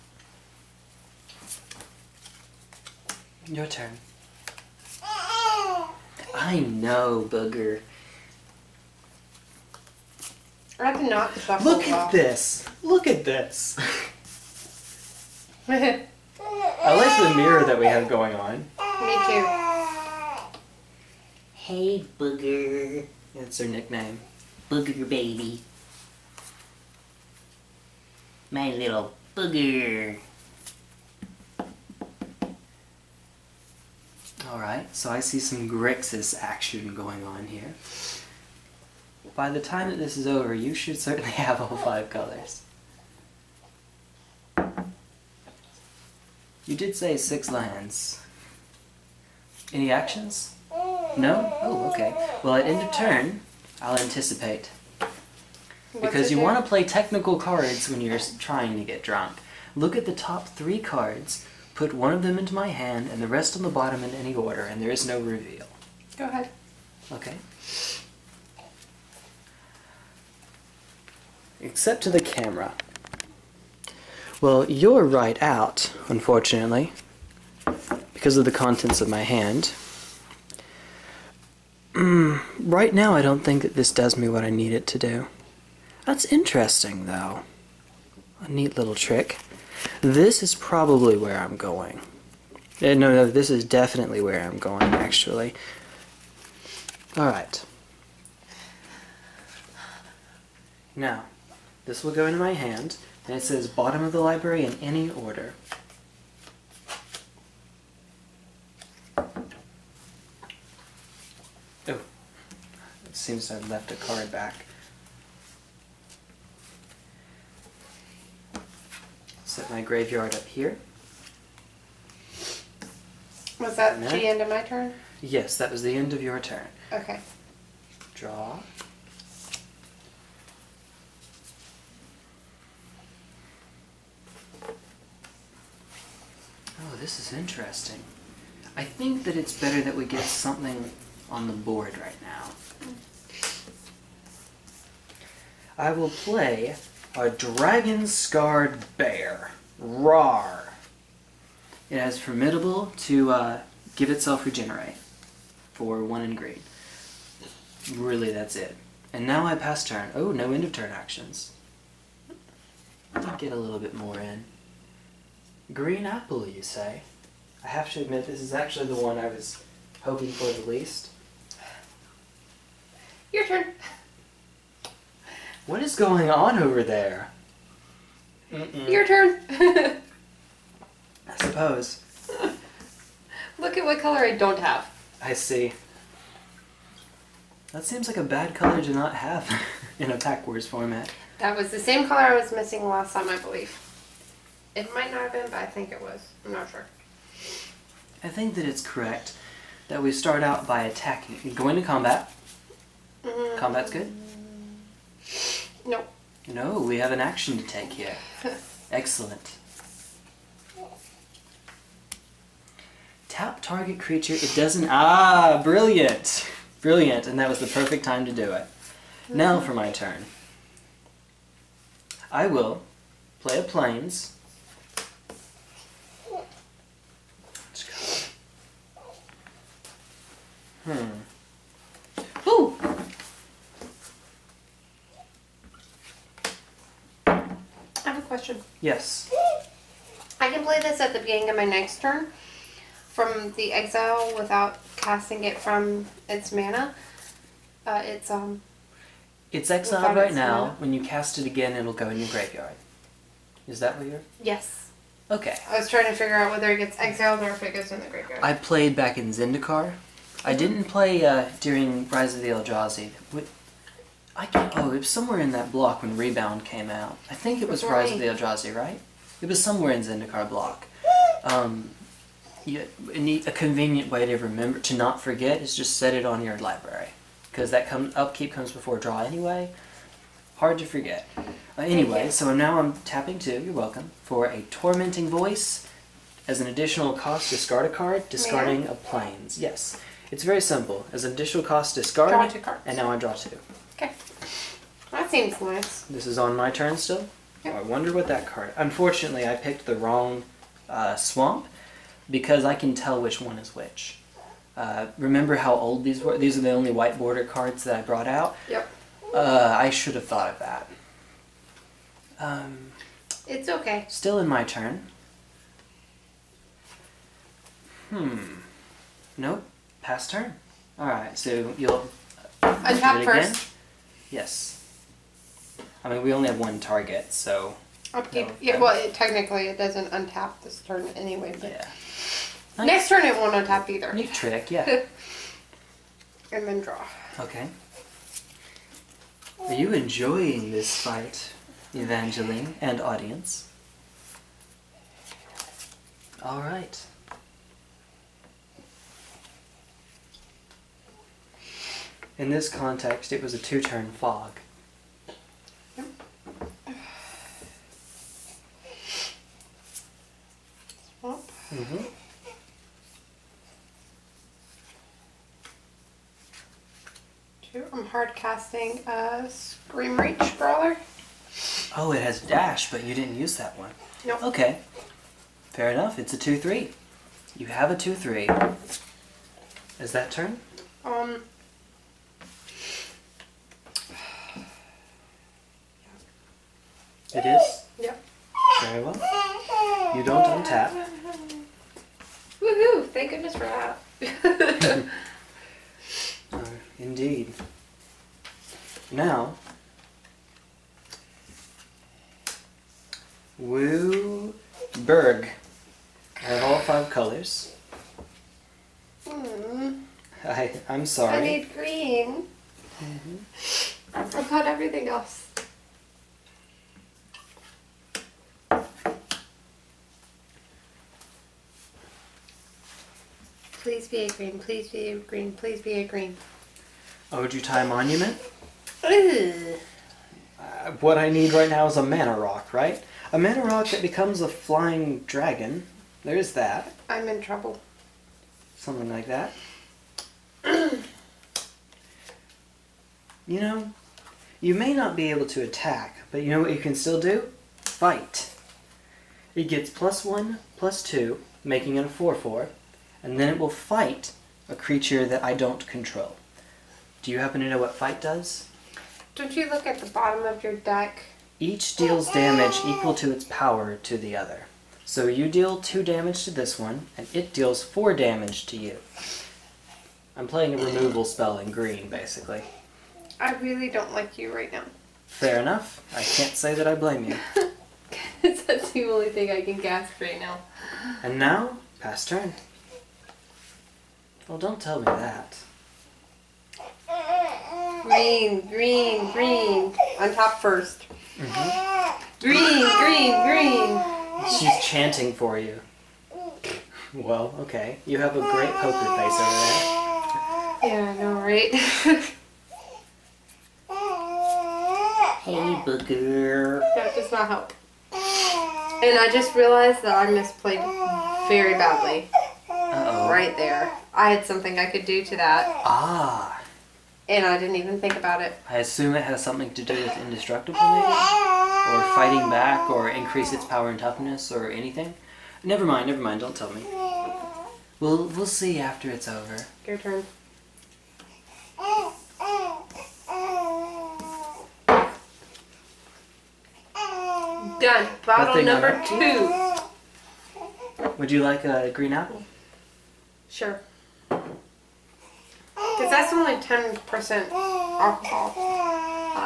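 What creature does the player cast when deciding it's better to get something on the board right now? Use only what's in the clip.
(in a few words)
Dragon-Scarred Bear.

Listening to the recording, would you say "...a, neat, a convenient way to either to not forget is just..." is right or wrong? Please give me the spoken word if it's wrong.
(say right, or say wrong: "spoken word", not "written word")
wrong: "remember", not "either".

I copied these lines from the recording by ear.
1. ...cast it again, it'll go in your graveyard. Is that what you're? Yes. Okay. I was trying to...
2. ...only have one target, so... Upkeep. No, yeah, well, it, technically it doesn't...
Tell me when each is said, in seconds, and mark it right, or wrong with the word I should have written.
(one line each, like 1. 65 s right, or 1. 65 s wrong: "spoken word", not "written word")
1. 251 s right
2. 326 s right.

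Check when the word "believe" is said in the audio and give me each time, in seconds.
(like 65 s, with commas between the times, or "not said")
193 s.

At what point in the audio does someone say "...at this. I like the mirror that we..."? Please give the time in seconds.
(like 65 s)
13 s.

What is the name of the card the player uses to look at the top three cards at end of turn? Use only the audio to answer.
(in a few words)
Anticipate.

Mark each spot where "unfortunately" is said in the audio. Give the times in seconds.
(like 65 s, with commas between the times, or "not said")
76 s, 298 s.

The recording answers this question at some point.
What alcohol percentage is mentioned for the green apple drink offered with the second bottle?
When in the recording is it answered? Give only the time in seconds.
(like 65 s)
546 s.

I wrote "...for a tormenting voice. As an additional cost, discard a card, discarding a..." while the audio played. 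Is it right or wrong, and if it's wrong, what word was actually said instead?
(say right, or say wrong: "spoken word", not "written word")
right.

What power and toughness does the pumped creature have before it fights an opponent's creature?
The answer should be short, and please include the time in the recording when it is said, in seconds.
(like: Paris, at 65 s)
4-4, at 452 s.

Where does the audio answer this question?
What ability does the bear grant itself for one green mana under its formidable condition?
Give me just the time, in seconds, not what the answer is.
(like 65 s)
154 s.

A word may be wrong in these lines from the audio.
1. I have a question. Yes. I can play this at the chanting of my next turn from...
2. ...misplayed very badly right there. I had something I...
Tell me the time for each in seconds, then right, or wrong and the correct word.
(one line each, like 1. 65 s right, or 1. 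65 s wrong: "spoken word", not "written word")
1. 237 s wrong: "beginning", not "chanting"
2. 510 s right.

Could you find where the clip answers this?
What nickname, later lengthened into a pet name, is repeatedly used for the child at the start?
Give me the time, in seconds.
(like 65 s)
24 s.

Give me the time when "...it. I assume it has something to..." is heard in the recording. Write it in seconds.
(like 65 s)
518 s.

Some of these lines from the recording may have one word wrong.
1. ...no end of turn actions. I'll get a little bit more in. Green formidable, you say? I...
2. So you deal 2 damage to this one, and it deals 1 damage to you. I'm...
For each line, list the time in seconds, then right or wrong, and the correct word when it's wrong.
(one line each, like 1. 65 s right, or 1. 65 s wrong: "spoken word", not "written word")
1. 160 s wrong: "apple", not "formidable"
2. 465 s wrong: "4", not "1".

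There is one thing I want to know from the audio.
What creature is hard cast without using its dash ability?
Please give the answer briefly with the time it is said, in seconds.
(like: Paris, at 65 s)
Screamreach Brawler, at 369 s.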